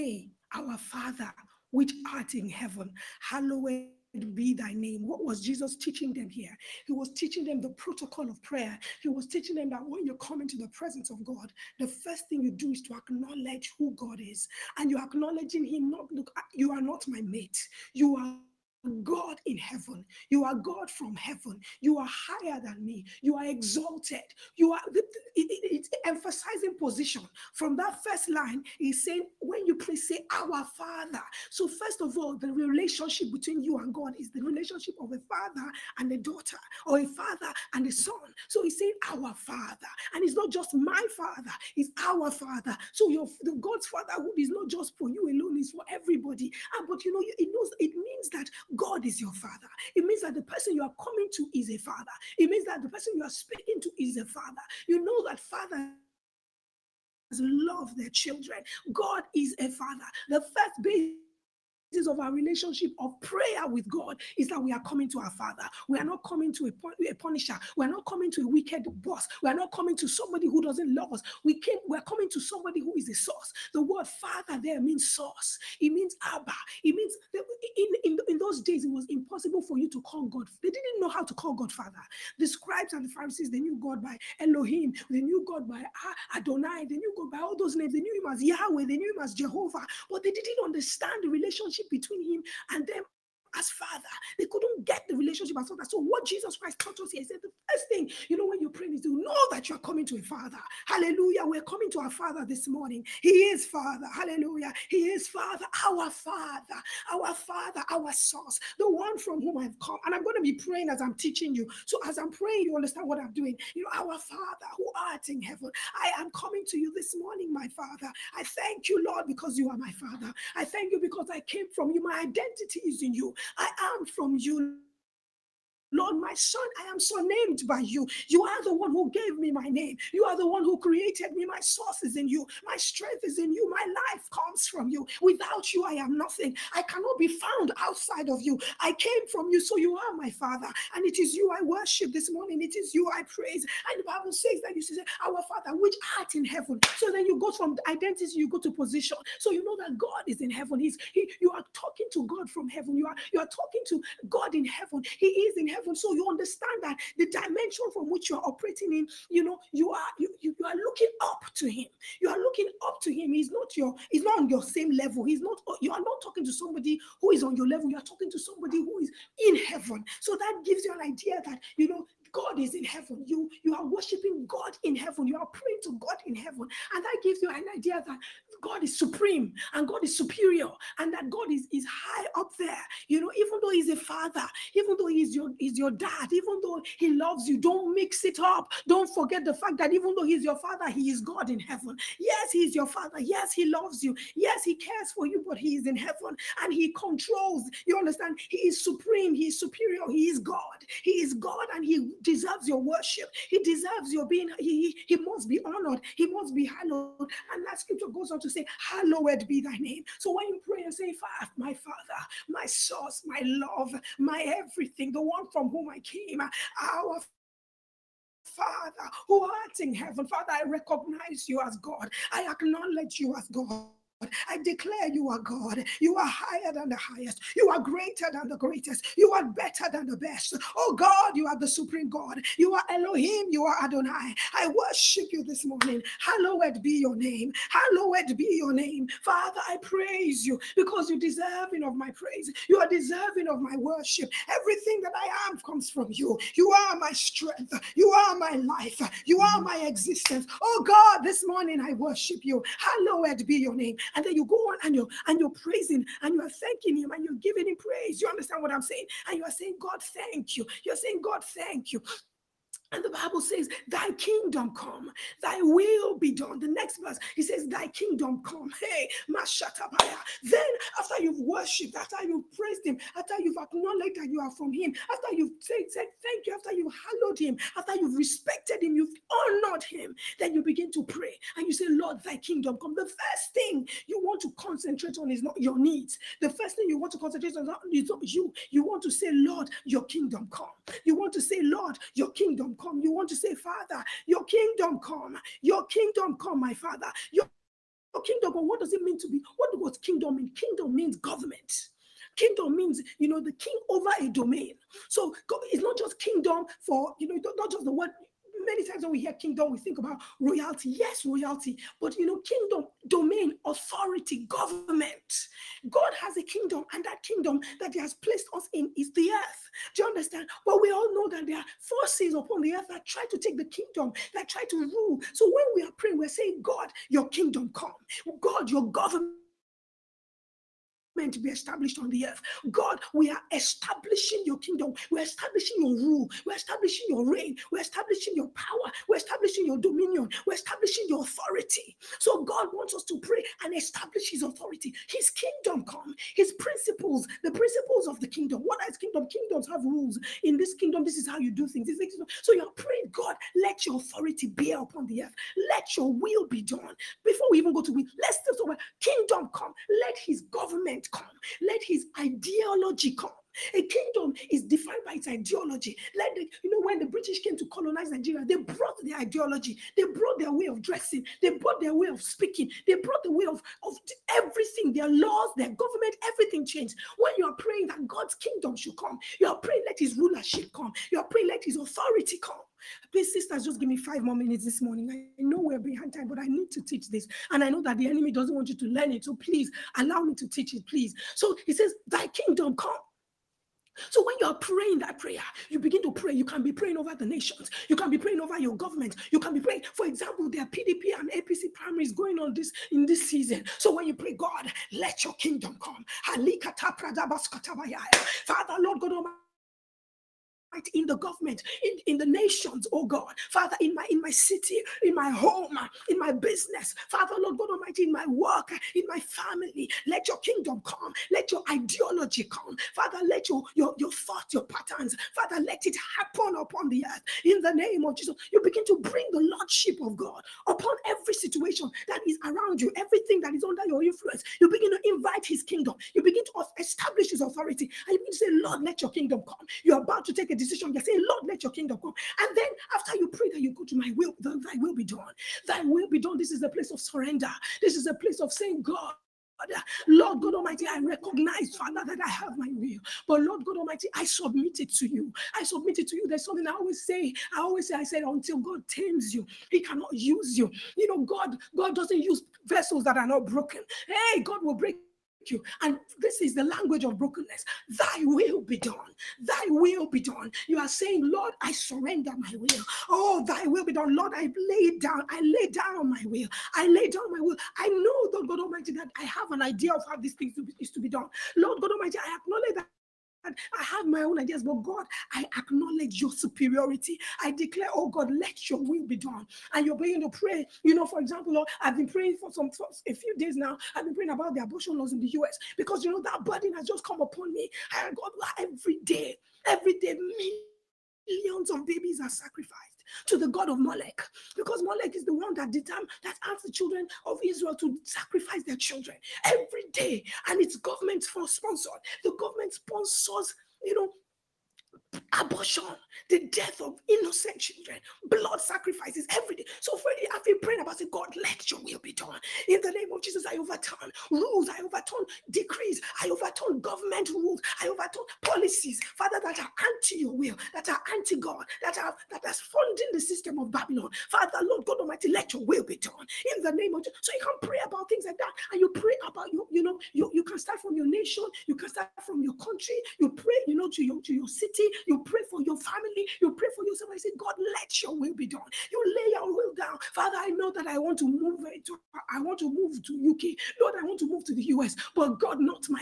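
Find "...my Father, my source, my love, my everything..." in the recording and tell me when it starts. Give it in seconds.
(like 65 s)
211 s.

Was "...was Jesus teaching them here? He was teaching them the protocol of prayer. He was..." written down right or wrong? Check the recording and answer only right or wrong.
right.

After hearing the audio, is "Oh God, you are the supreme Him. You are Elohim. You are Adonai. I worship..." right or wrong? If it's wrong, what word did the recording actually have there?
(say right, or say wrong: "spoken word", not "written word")
wrong: "God", not "Him".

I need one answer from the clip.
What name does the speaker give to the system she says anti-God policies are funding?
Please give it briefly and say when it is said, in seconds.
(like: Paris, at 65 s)
Babylon, at 533 s.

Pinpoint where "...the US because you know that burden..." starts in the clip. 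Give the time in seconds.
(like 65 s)
495 s.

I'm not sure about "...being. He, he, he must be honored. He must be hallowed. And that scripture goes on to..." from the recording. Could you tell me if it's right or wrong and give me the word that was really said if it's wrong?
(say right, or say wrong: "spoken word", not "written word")
right.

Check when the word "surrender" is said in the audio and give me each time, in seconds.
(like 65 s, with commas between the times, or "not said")
446 s, 471 s.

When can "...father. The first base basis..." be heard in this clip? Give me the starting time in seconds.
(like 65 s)
59 s.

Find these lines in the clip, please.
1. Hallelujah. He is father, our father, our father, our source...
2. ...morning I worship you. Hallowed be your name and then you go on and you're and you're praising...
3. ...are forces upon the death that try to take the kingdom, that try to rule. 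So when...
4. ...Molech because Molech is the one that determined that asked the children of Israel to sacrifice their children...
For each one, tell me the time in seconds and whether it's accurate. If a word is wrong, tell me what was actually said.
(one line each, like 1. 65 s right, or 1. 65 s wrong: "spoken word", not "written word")
1. 104 s right
2. 251 s right
3. 321 s wrong: "earth", not "death"
4. 503 s right.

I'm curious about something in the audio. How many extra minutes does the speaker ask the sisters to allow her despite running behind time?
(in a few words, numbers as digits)
5.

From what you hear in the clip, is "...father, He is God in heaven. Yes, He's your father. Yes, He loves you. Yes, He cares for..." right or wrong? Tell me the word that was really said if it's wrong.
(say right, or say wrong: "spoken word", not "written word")
right.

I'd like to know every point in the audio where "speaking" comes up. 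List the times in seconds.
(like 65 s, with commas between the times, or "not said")
53 s, 372 s.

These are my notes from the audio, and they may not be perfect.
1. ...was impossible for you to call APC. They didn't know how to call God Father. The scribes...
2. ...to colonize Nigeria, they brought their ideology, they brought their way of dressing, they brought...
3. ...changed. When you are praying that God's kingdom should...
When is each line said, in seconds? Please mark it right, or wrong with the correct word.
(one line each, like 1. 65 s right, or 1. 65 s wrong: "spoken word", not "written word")
1. 78 s wrong: "God", not "APC"
2. 367 s right
3. 376 s right.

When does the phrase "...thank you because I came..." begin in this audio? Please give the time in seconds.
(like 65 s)
120 s.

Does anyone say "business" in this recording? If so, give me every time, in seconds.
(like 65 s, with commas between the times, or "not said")
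416 s.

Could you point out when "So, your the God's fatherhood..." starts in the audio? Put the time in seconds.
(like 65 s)
42 s.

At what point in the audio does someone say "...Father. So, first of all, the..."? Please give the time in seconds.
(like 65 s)
30 s.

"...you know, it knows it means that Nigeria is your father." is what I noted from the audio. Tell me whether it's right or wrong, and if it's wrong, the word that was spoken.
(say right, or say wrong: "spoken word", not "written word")
wrong: "God", not "Nigeria".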